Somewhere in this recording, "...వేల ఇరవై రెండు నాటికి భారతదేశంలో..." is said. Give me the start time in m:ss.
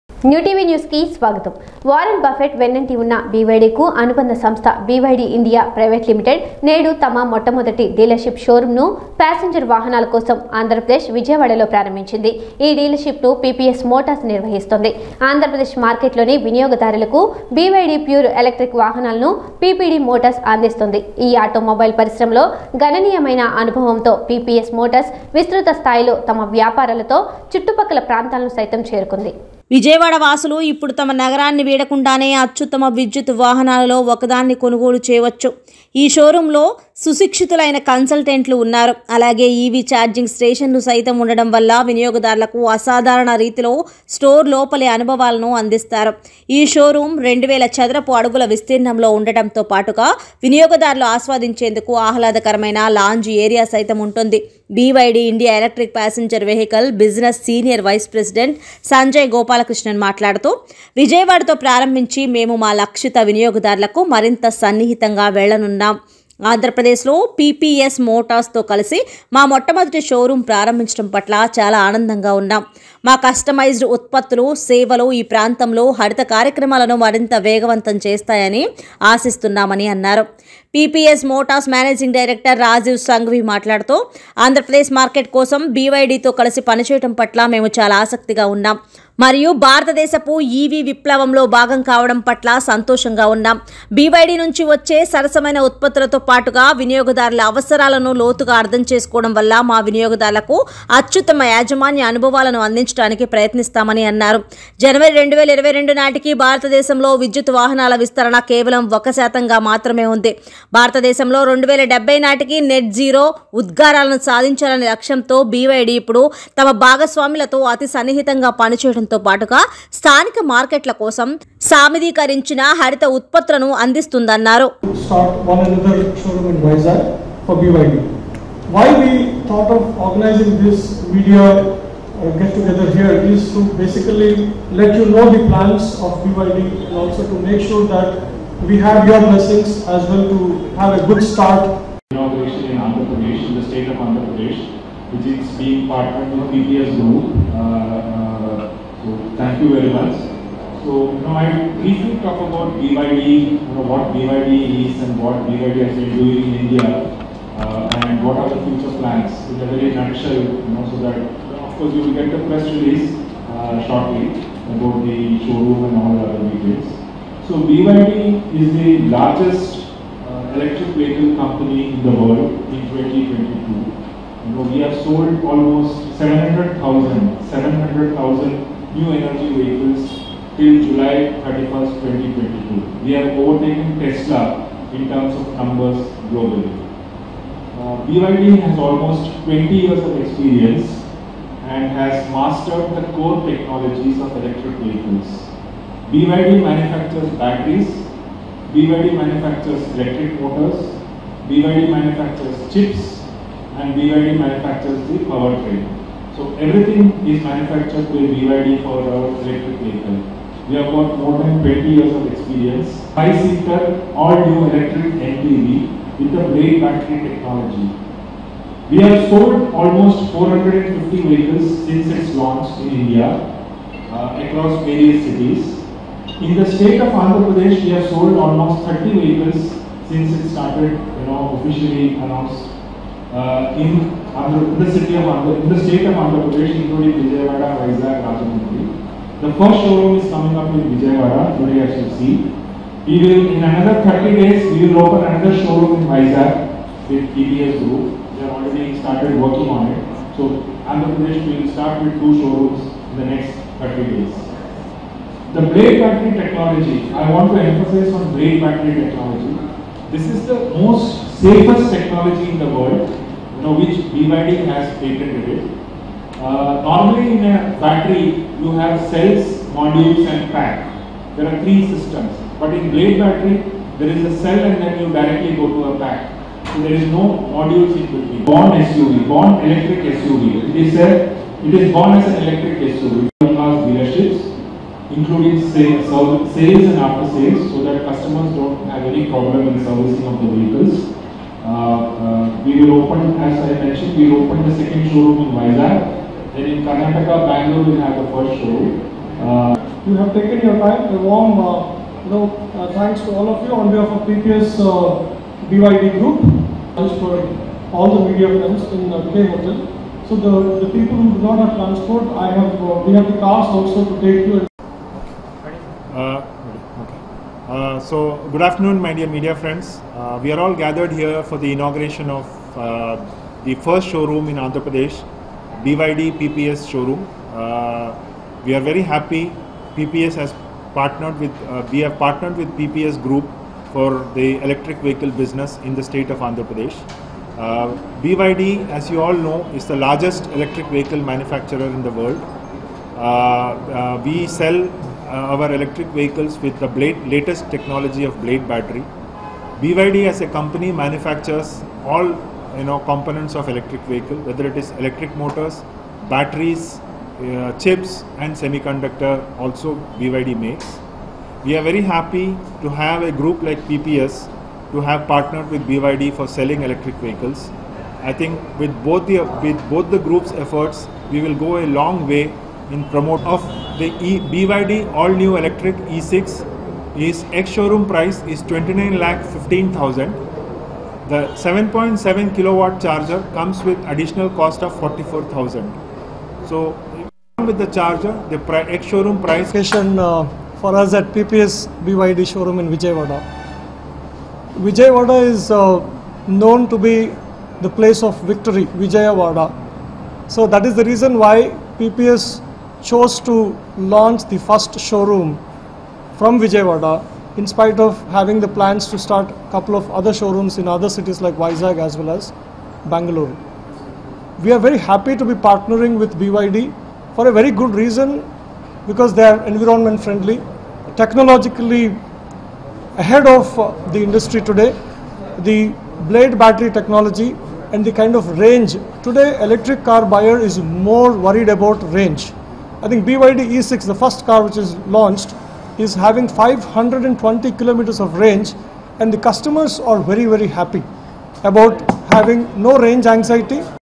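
1:45.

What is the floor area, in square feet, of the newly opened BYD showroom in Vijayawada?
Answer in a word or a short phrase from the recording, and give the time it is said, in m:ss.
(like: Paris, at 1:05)
2000 square feet, at 0:47.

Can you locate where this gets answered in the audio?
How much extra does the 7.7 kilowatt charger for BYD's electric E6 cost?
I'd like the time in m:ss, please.
6:24.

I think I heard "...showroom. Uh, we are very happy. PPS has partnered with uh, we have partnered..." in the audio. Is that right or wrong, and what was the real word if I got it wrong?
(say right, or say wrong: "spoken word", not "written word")
right.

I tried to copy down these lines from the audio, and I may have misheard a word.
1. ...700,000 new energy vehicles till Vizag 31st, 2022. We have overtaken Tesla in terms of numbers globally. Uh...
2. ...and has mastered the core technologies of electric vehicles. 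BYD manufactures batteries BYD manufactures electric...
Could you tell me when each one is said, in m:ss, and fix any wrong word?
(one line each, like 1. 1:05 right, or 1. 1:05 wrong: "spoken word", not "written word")
1. 2:57 wrong: "July", not "Vizag"
2. 3:11 right.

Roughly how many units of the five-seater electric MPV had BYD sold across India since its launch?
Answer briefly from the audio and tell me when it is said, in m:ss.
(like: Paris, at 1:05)
450, at 3:40.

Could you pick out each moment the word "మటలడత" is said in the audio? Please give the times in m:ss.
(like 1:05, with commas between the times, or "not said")
1:00, 1:23.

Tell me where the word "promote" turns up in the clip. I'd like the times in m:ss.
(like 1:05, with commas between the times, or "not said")
6:13.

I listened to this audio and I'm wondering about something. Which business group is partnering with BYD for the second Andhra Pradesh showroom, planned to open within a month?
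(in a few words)
TBS Group.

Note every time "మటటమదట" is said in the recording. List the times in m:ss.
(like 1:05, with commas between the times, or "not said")
0:07, 1:09.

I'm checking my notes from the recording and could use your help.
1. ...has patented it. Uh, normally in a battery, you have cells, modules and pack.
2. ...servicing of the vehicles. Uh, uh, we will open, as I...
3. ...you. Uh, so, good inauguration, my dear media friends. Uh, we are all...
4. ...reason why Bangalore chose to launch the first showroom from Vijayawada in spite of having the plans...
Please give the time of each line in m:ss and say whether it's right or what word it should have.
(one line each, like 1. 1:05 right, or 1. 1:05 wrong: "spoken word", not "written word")
1. 4:24 right
2. 4:49 right
3. 5:14 wrong: "afternoon", not "inauguration"
4. 6:41 wrong: "PPS", not "Bangalore".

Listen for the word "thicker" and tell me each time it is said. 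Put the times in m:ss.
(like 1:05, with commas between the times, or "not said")
not said.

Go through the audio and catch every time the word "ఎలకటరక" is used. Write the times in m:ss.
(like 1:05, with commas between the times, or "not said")
0:18, 0:55.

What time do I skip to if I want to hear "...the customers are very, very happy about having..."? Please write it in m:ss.
7:19.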